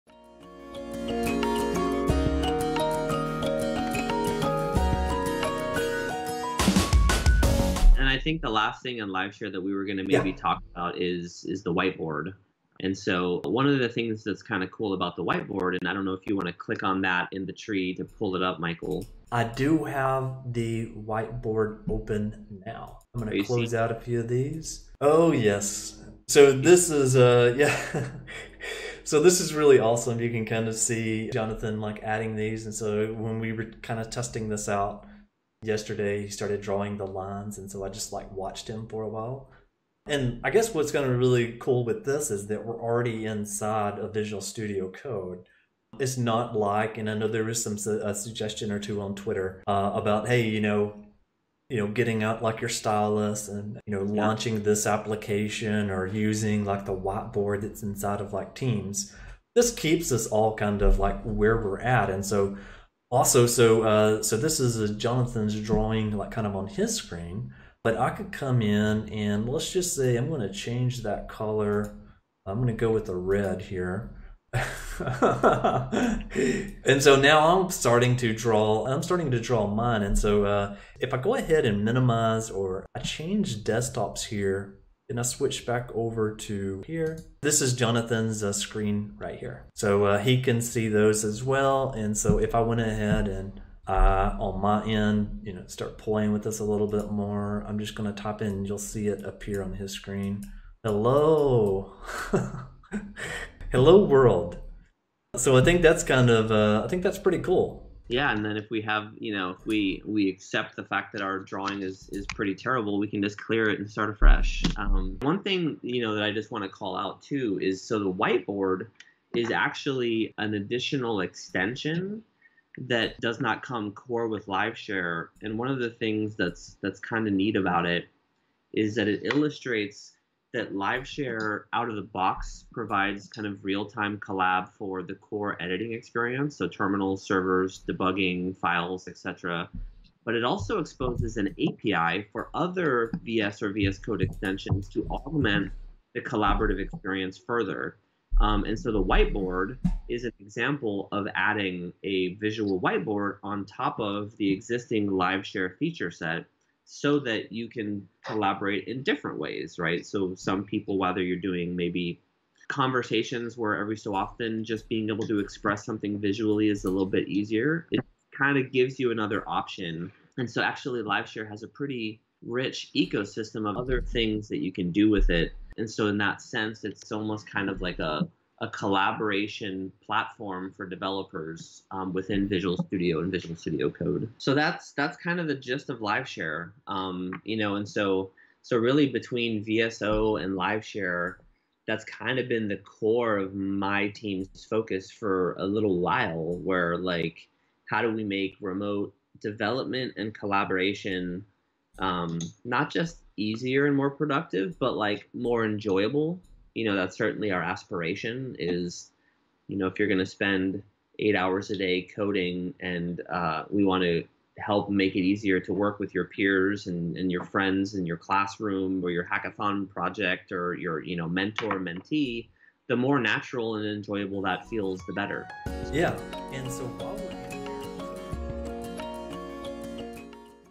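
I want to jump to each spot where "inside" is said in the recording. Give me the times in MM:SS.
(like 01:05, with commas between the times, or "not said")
00:43, 00:57.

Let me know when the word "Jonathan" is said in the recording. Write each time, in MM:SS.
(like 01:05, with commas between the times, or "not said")
00:31, 01:04, 01:27.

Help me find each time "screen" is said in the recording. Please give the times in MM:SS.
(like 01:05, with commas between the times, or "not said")
01:06, 01:28, 01:39.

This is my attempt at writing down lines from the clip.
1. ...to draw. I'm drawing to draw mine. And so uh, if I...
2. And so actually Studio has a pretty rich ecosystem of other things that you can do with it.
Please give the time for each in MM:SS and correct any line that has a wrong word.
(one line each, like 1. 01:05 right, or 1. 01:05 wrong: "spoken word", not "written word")
1. 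01:18 wrong: "starting", not "drawing"
2. 02:50 wrong: "LiveShare", not "Studio".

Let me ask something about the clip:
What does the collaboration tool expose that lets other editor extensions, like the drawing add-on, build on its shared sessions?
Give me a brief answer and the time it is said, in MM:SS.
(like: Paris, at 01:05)
An API, at 02:21.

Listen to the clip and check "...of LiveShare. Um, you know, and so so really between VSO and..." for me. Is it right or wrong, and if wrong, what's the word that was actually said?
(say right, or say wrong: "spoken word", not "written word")
right.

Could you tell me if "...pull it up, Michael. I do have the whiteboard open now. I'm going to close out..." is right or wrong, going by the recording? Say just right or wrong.
right.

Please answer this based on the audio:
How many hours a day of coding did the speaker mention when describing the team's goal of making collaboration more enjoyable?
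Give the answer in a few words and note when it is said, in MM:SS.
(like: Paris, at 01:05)
8, at 03:31.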